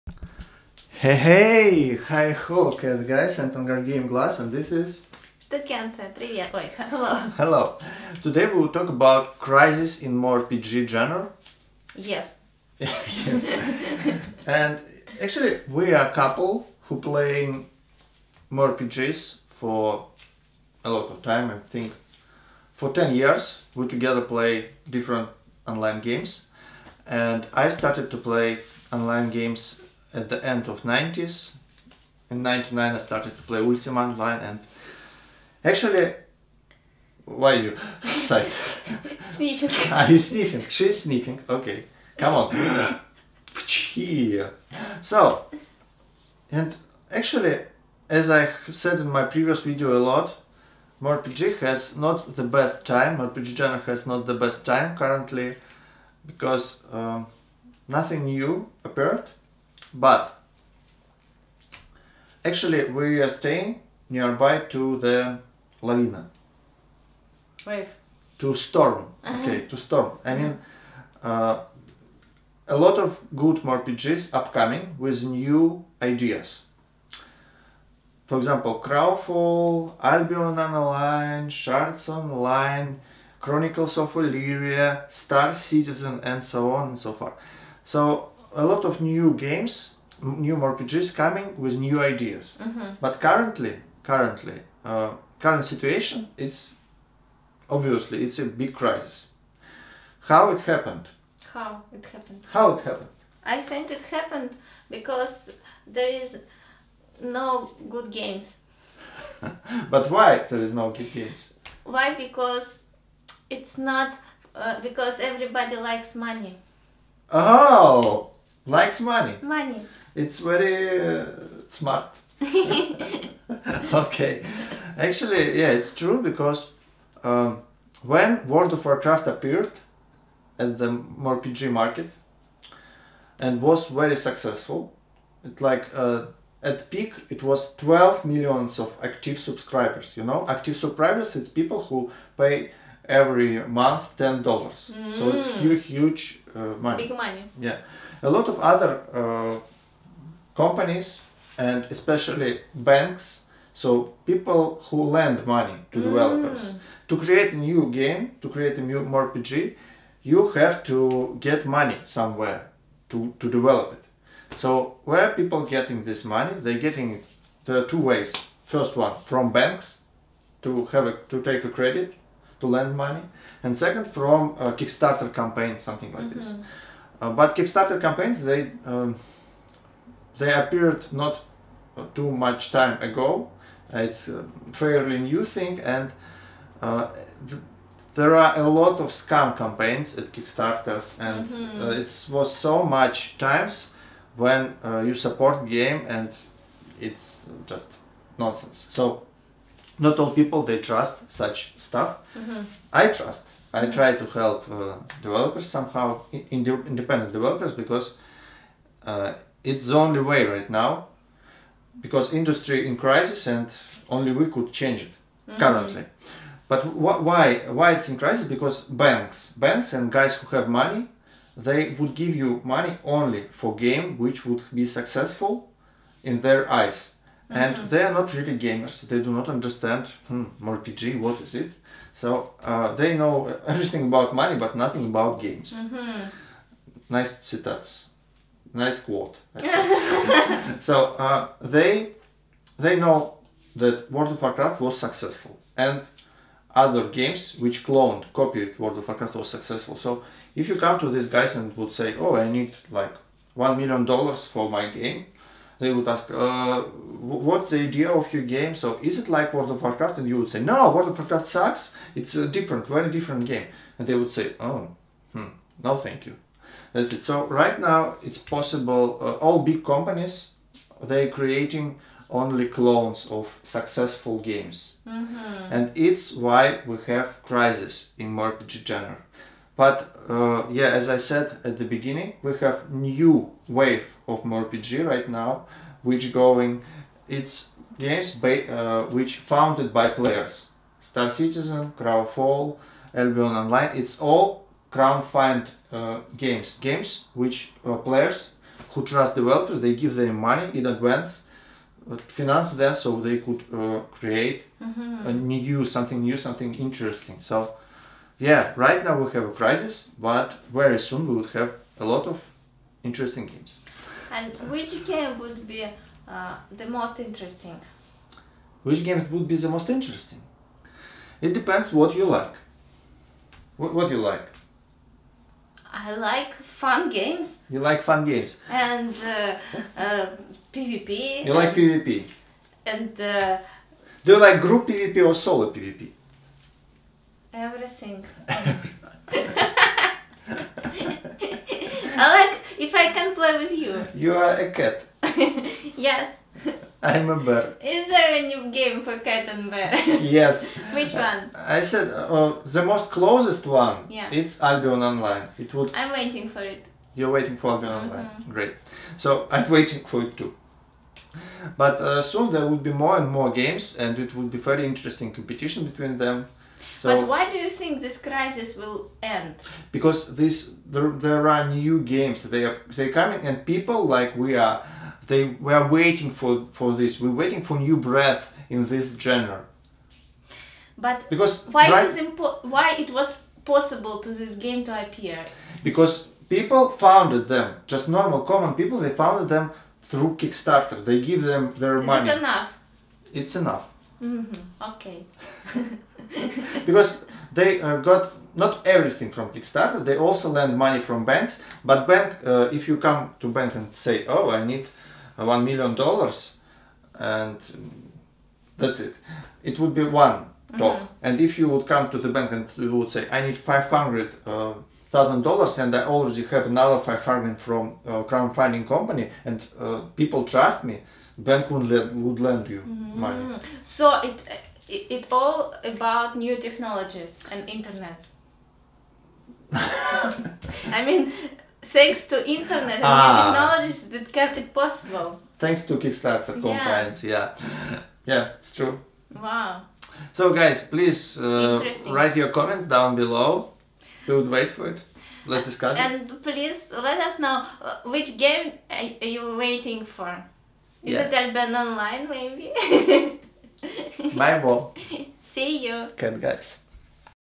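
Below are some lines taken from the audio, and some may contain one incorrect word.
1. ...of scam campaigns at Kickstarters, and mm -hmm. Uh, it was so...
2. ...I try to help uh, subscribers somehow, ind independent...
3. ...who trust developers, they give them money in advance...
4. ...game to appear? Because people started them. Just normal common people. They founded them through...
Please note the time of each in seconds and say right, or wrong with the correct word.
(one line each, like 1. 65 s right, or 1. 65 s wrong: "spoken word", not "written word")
1. 188 s right
2. 203 s wrong: "developers", not "subscribers"
3. 298 s right
4. 384 s wrong: "founded", not "started".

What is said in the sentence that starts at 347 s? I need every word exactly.
Is there a new game for cat and bear?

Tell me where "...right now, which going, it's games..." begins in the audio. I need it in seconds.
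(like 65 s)
285 s.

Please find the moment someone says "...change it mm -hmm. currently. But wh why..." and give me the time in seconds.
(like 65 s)
214 s.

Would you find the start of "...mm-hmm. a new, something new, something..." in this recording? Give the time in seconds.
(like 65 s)
304 s.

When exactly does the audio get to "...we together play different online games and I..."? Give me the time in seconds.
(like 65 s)
23 s.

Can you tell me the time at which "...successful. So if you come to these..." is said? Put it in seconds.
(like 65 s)
249 s.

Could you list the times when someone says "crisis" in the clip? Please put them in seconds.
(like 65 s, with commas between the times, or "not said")
9 s, 98 s, 212 s, 218 s, 277 s, 309 s, 368 s.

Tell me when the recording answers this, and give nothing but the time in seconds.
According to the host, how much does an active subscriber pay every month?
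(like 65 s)
144 s.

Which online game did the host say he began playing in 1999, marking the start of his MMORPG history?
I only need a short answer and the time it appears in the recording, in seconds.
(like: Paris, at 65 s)
Ultima Online, at 33 s.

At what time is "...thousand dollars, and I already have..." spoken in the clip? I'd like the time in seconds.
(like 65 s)
415 s.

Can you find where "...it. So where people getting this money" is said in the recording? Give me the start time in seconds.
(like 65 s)
163 s.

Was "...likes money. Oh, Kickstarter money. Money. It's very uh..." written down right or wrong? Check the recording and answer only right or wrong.
wrong.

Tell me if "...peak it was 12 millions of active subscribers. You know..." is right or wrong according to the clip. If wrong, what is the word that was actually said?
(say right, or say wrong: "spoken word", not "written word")
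right.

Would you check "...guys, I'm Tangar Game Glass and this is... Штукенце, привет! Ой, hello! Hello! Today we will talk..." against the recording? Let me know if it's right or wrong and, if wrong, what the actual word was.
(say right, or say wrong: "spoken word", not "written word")
right.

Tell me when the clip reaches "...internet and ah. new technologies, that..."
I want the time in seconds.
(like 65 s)
432 s.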